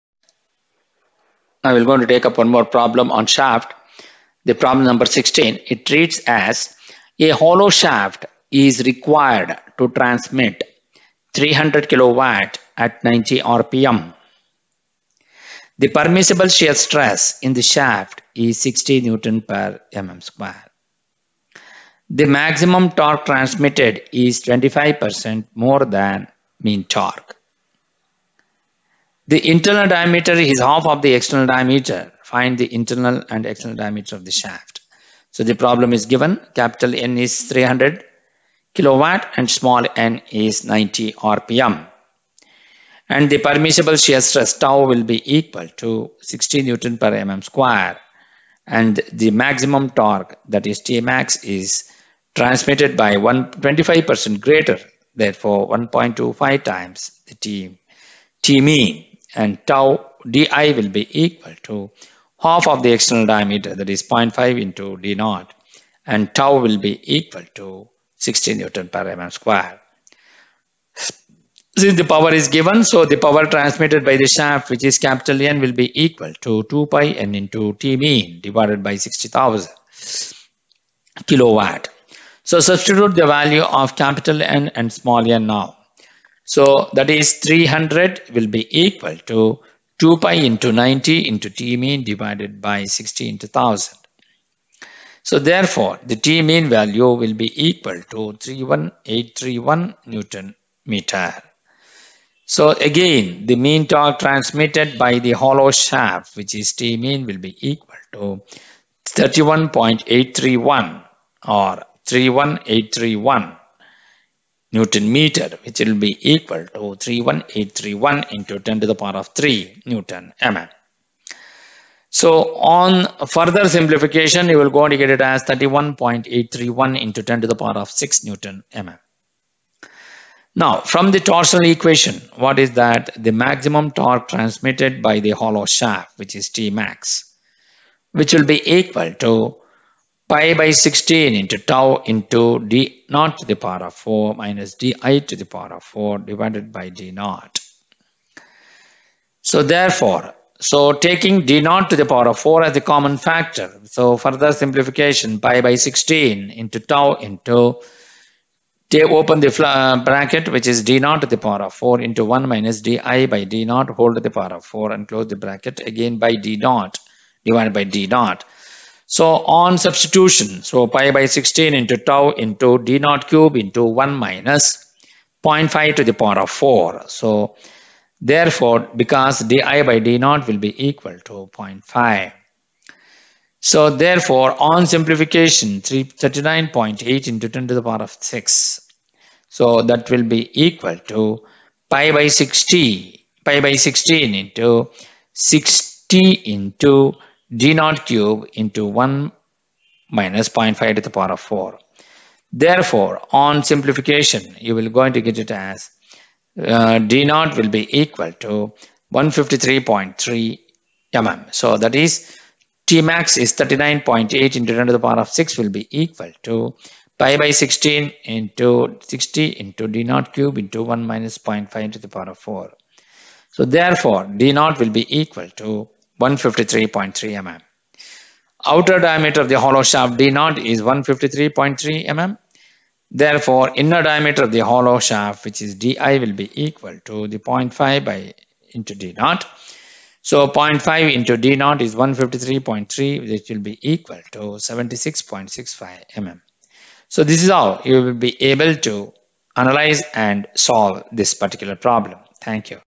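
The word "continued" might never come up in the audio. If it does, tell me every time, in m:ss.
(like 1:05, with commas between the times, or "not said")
not said.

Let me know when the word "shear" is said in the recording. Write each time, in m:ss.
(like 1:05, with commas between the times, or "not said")
0:16, 0:43.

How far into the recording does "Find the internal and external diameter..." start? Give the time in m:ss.
0:32.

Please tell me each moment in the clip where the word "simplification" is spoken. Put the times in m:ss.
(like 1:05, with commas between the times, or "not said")
2:03, 2:34, 3:04, 3:23.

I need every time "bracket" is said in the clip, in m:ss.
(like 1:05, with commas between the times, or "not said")
2:40, 2:45.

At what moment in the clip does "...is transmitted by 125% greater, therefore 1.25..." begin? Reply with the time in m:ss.
0:51.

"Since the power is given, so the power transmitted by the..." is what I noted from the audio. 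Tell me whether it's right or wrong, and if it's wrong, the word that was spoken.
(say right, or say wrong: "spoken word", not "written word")
right.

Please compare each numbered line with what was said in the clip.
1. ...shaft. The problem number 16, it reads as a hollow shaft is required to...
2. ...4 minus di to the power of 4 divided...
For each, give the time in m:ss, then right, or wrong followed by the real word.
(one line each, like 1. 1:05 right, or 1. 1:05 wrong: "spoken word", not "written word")
1. 0:03 right
2. 2:24 right.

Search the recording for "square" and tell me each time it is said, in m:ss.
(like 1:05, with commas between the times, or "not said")
0:20, 0:47, 1:09.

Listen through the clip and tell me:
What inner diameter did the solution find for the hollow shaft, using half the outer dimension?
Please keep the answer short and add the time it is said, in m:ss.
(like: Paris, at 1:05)
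76.65 mm, at 4:04.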